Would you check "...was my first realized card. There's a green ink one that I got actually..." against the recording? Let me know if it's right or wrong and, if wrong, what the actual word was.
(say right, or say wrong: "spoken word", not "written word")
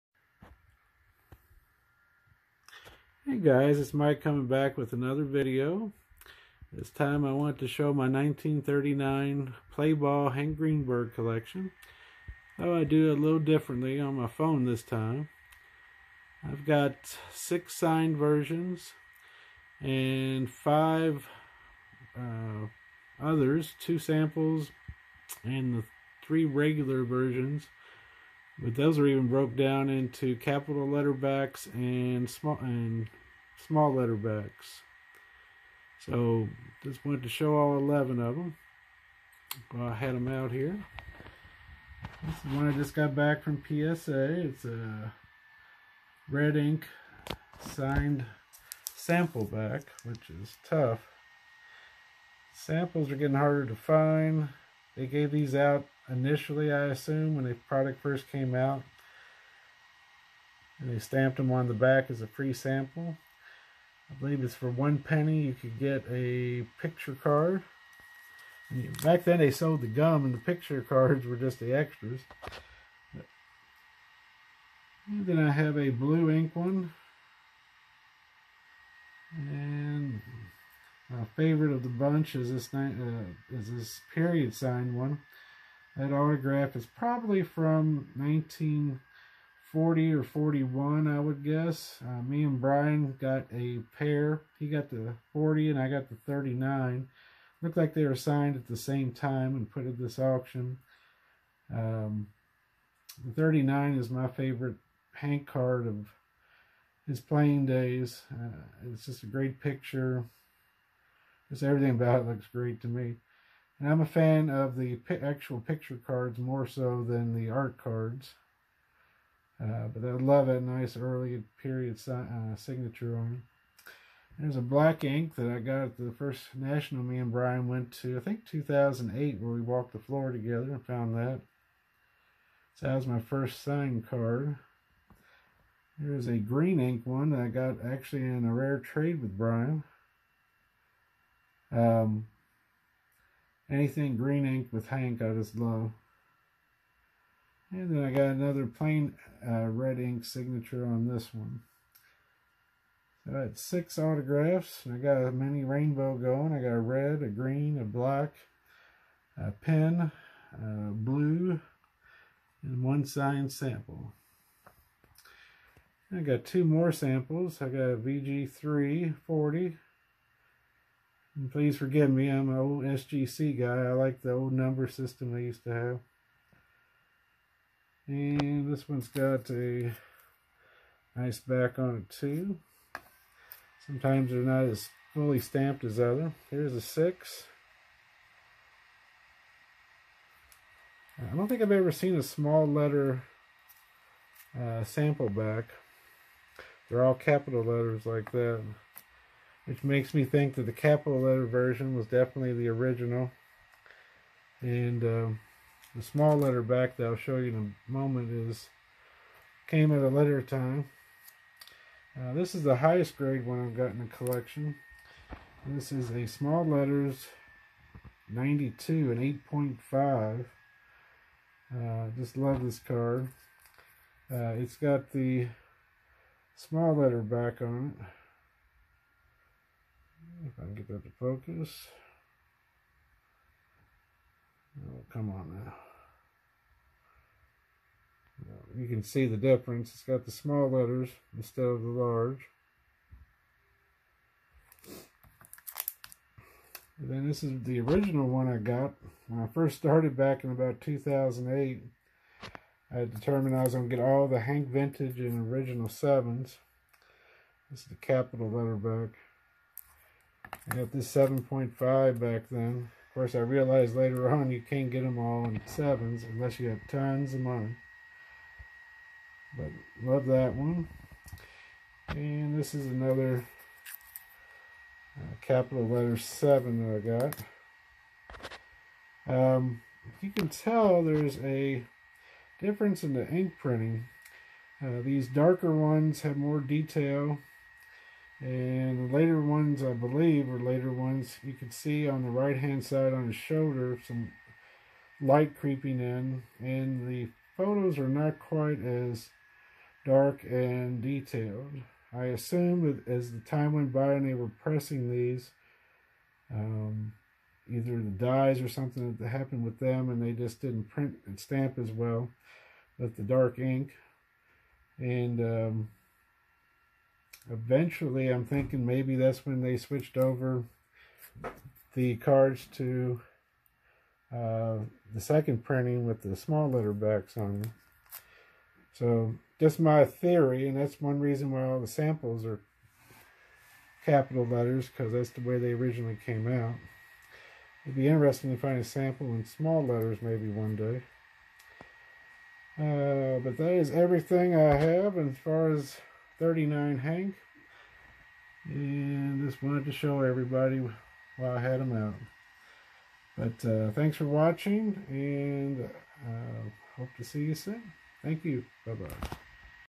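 wrong: "signed", not "realized".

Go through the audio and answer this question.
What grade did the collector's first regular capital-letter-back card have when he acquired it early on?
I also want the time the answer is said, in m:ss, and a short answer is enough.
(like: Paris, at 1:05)
7.5, at 4:21.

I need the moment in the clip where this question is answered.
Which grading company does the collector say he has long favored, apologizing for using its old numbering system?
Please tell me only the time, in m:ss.
2:52.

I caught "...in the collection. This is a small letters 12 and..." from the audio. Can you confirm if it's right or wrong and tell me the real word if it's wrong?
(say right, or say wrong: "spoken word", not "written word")
wrong: "92", not "12".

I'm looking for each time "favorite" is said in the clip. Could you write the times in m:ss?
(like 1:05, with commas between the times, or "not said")
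1:21, 1:44.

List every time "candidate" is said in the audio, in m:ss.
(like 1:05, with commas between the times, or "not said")
not said.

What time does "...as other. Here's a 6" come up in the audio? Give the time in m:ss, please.
3:05.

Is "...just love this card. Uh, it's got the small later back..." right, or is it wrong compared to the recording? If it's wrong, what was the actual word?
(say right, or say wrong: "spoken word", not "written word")
wrong: "letter", not "later".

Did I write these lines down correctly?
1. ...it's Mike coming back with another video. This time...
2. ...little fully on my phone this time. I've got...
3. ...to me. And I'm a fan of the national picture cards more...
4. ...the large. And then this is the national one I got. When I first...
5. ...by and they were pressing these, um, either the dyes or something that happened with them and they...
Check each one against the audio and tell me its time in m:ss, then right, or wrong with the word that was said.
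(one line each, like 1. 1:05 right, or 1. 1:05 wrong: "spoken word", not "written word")
1. 0:03 right
2. 0:13 wrong: "differently", not "fully"
3. 1:52 wrong: "actual", not "national"
4. 4:01 wrong: "original", not "national"
5. 5:03 right.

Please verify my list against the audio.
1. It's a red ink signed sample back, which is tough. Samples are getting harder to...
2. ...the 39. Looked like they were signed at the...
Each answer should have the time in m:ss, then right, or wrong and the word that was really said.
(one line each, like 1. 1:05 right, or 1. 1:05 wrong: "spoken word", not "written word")
1. 0:44 right
2. 1:36 right.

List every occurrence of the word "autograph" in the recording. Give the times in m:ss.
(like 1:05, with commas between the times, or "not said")
1:26, 2:33.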